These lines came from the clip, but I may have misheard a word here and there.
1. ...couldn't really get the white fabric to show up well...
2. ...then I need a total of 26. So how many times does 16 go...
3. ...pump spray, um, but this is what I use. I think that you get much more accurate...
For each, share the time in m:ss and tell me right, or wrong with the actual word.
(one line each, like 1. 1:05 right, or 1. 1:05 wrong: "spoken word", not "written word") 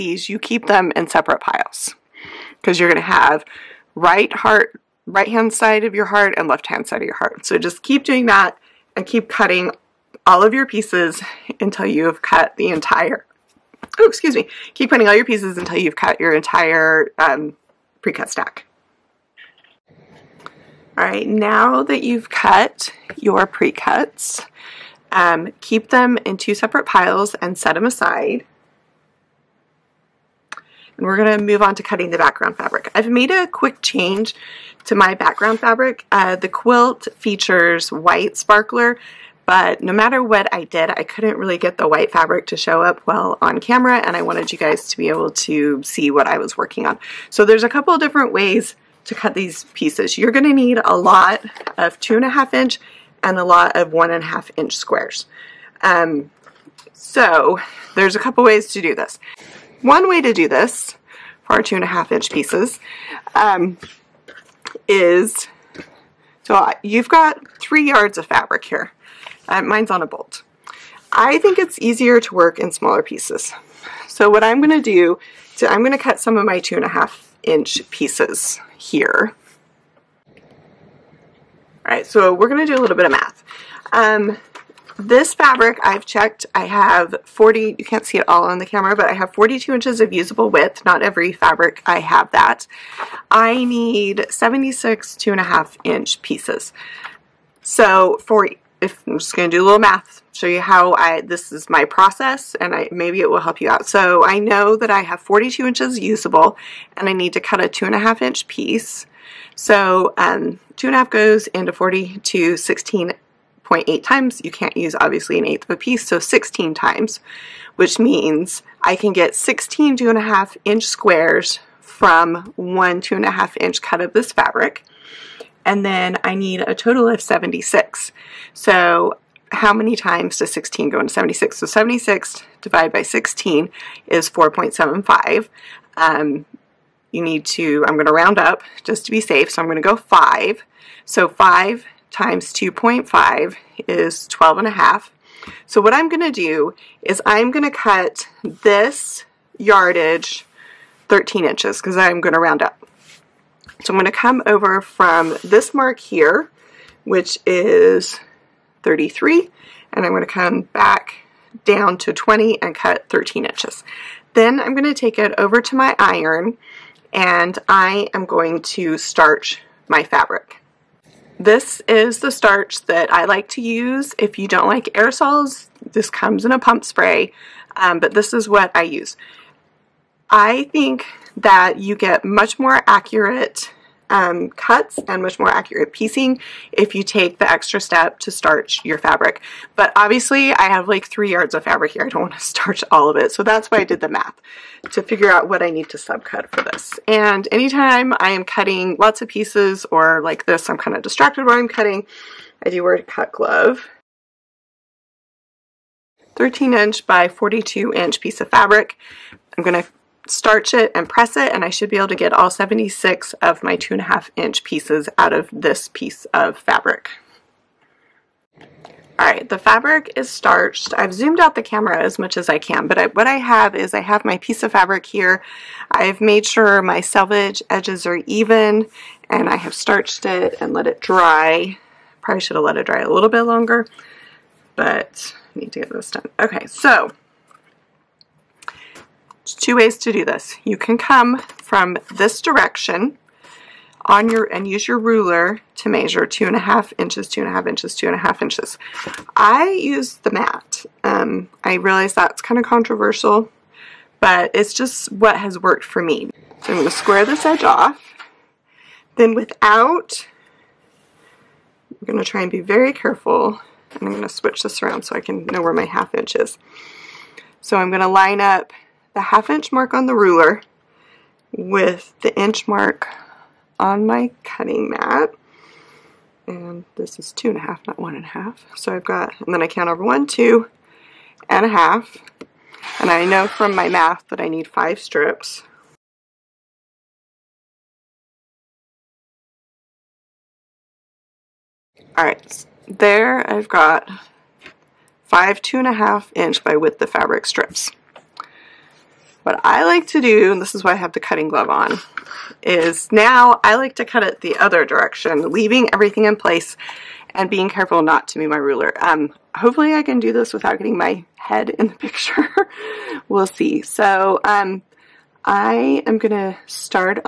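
1. 0:41 right
2. 2:05 wrong: "76", not "26"
3. 2:56 right.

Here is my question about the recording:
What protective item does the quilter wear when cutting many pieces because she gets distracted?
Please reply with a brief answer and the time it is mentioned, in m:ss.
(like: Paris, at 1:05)
A cut glove, at 3:23.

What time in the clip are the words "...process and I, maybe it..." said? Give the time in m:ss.
1:41.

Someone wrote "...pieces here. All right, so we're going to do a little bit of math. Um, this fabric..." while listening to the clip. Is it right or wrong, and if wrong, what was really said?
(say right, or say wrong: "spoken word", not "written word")
right.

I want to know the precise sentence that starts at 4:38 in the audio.
So I've got, and then I count over one, two, and a half.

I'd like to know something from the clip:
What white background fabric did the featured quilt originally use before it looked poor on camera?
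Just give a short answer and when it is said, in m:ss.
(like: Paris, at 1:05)
White sparkler, at 0:37.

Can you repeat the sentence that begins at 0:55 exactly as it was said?
Um, so there's a couple ways to do this.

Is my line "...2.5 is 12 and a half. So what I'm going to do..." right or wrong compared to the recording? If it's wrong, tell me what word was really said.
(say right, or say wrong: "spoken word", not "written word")
right.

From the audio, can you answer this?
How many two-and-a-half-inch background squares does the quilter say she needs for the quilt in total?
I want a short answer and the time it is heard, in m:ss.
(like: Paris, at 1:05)
76, at 1:34.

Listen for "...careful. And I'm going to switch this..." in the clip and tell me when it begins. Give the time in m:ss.
4:22.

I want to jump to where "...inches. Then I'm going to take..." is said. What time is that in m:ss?
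2:43.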